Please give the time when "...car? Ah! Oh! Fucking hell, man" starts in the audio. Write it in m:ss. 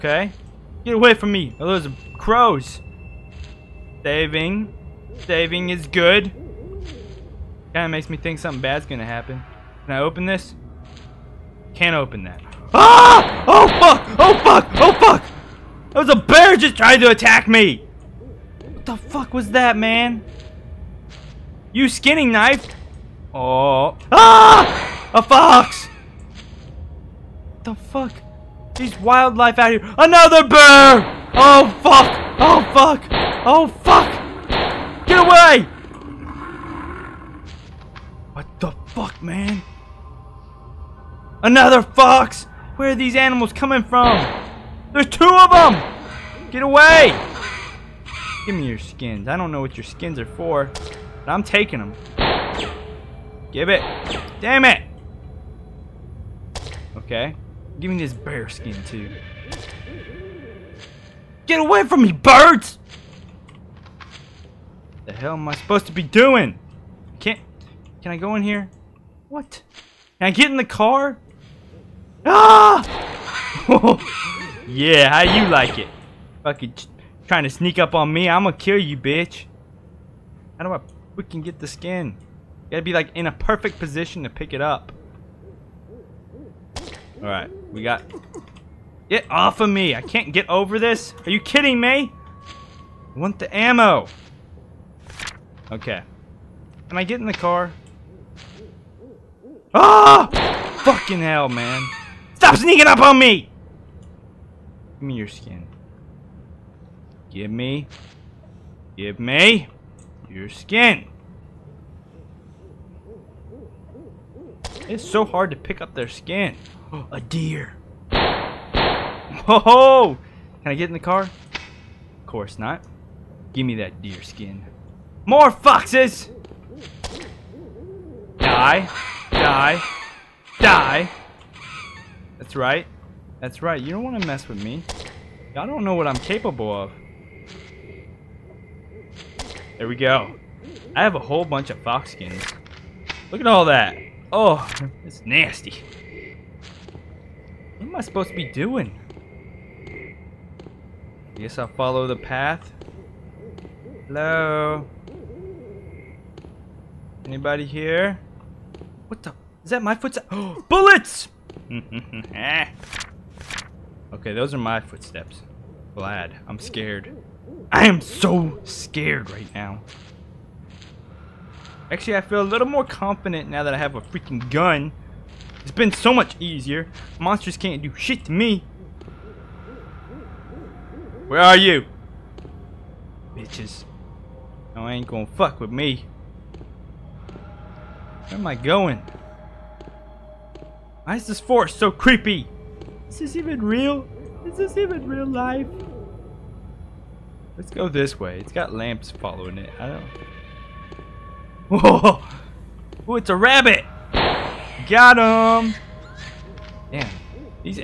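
1:37.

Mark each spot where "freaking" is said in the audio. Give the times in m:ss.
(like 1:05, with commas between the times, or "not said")
1:21, 2:54.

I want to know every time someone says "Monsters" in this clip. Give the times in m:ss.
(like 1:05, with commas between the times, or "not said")
2:57.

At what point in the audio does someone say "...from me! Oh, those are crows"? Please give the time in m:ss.
0:01.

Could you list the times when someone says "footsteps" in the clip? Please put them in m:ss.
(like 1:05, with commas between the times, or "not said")
2:39, 2:44.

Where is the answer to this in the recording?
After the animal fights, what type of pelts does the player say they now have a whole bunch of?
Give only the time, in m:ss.
2:21.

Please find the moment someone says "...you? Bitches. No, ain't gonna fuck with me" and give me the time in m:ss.
3:01.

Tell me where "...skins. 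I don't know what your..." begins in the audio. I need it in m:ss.
0:48.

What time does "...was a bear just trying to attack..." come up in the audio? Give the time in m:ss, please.
0:16.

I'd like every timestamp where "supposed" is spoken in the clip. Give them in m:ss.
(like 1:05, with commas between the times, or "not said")
1:05, 2:28.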